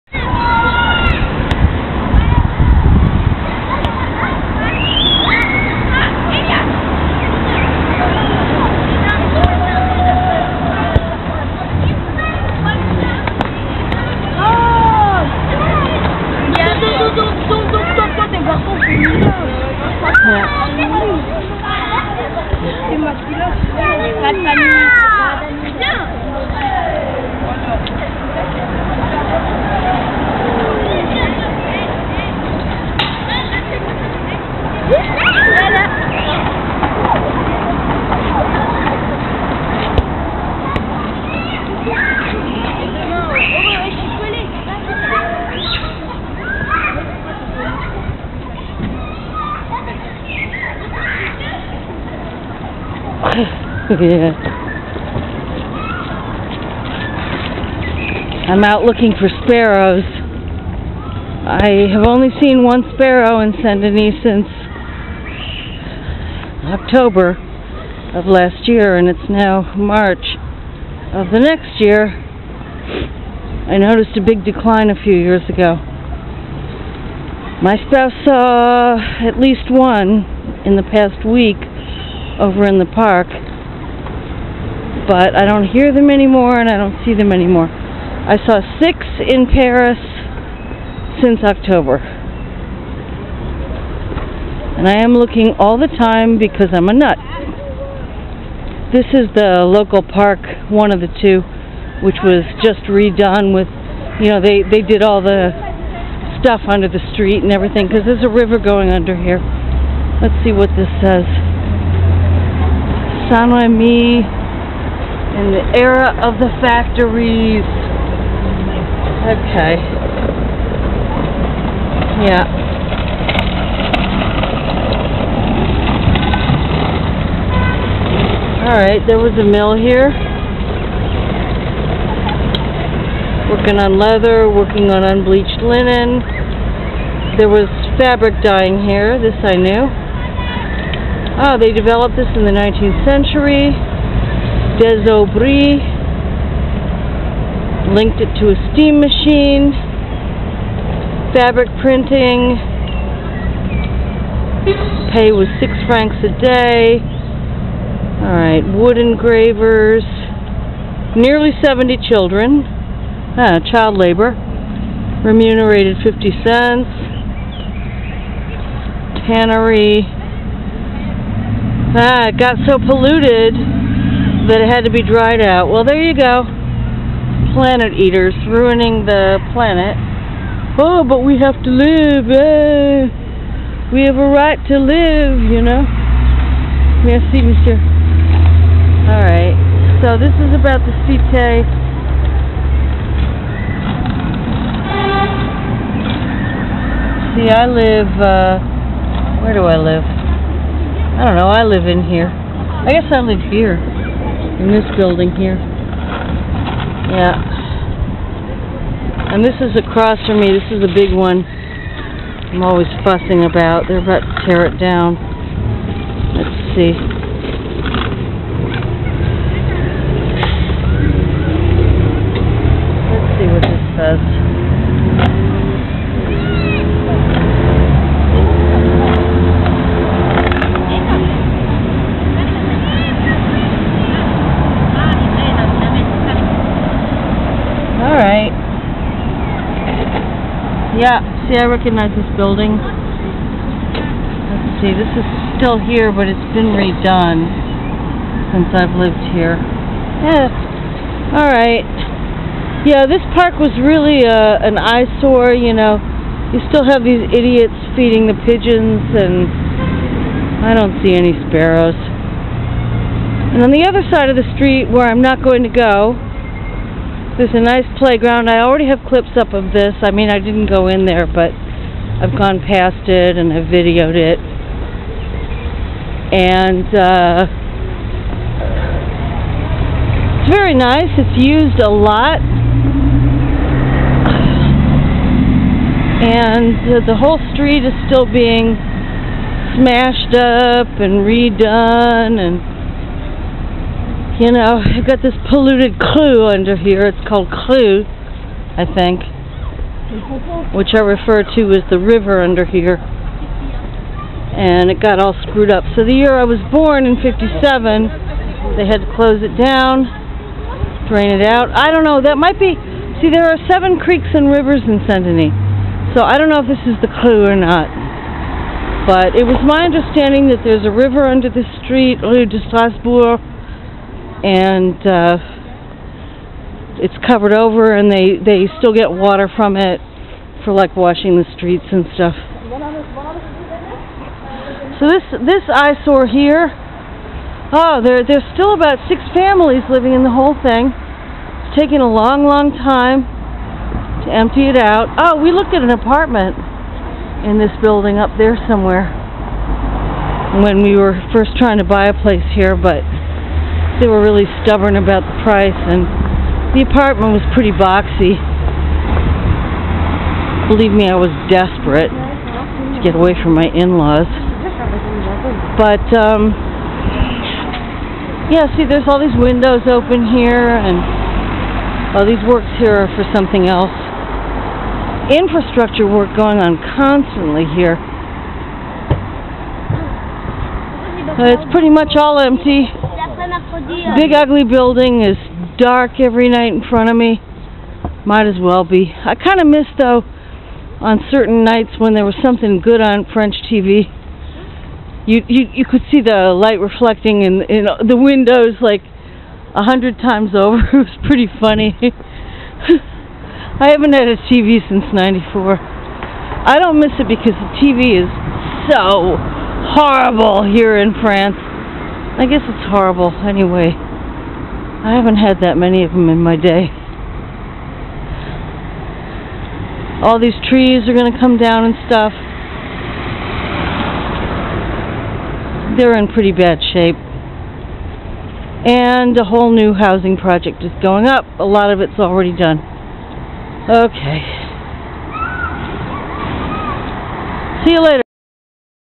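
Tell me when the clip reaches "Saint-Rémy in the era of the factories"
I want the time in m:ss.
1:53.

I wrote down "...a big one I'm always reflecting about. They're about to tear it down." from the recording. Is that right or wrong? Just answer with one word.
wrong.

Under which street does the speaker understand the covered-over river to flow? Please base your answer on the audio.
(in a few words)
Rue de Strasbourg.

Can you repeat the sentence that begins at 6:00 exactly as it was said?
Believe me, I was desperate to get away from my in-laws.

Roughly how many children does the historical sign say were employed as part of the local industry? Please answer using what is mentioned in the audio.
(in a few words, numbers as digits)
nearly 70.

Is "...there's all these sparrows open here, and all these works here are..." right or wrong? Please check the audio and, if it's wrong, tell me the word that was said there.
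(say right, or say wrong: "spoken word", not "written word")
wrong: "windows", not "sparrows".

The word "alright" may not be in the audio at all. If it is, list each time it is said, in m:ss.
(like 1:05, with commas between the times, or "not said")
2:08, 2:38, 3:09, 4:11.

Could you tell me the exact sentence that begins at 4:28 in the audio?
I already have clips up of this.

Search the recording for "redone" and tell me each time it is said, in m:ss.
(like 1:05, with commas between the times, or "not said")
1:42, 4:06, 4:51.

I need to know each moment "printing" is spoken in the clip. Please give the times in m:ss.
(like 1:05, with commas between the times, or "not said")
2:31.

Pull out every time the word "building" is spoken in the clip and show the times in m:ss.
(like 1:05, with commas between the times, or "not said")
3:24, 4:02, 5:47, 6:24.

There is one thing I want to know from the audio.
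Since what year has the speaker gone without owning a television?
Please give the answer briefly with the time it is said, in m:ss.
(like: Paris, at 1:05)
1994, at 6:45.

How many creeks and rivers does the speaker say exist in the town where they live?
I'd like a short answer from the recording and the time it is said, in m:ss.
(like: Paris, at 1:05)
7, at 5:13.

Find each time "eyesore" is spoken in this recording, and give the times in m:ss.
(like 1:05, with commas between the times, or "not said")
4:14, 5:35.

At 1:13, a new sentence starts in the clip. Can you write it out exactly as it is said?
I noticed a big decline a few years ago.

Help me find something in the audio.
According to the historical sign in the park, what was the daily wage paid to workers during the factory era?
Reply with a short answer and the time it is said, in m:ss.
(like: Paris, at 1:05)
6 francs, at 2:35.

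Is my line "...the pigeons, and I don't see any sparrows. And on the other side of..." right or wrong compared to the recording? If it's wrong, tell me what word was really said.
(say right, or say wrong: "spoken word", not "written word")
right.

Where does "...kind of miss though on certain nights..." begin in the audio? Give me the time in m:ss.
6:29.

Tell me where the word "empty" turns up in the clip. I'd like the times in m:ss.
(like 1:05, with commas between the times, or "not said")
5:44, 6:22.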